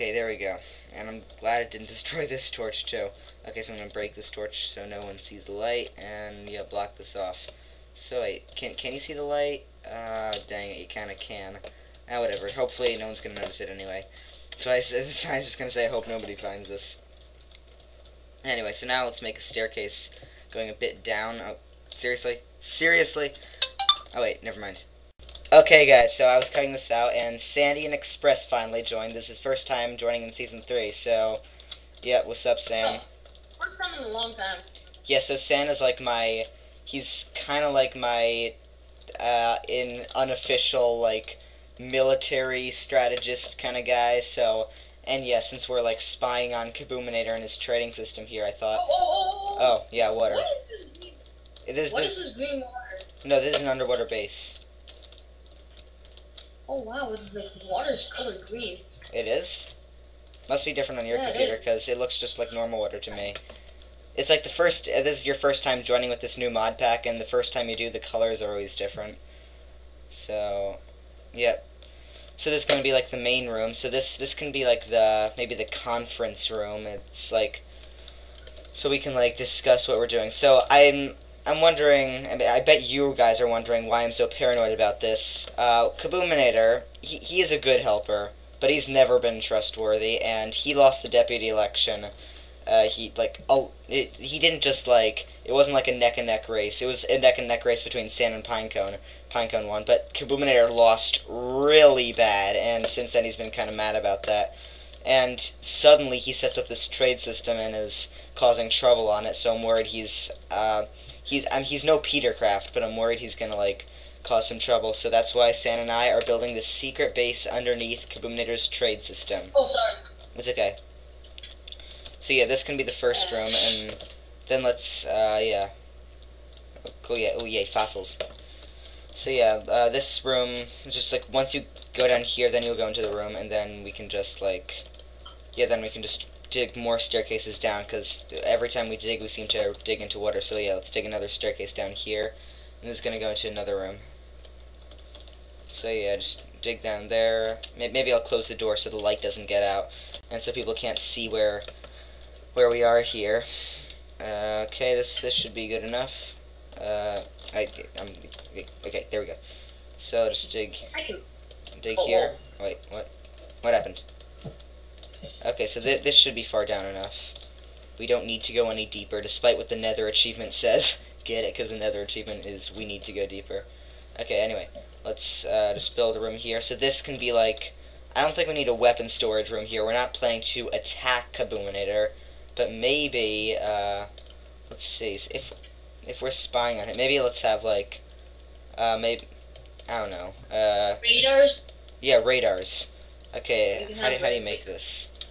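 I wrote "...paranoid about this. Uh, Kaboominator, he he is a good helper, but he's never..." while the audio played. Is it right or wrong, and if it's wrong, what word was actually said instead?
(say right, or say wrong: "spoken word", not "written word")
right.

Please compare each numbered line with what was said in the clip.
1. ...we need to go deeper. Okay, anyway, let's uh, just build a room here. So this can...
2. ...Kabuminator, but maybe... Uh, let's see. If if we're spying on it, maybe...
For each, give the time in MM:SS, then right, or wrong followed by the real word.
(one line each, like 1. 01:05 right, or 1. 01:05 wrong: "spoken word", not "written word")
1. 02:52 right
2. 03:01 right.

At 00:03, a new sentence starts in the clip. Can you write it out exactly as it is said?
Okay, so I'm going to break this torch so no one sees the light, and, yeah, block this off.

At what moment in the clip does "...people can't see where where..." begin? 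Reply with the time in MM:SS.
02:30.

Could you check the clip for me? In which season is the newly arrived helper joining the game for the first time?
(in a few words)
Season 3.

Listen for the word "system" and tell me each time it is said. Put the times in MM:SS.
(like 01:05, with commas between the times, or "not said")
00:47, 01:47, 01:59.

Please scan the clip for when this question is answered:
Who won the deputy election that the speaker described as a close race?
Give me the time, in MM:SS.
01:39.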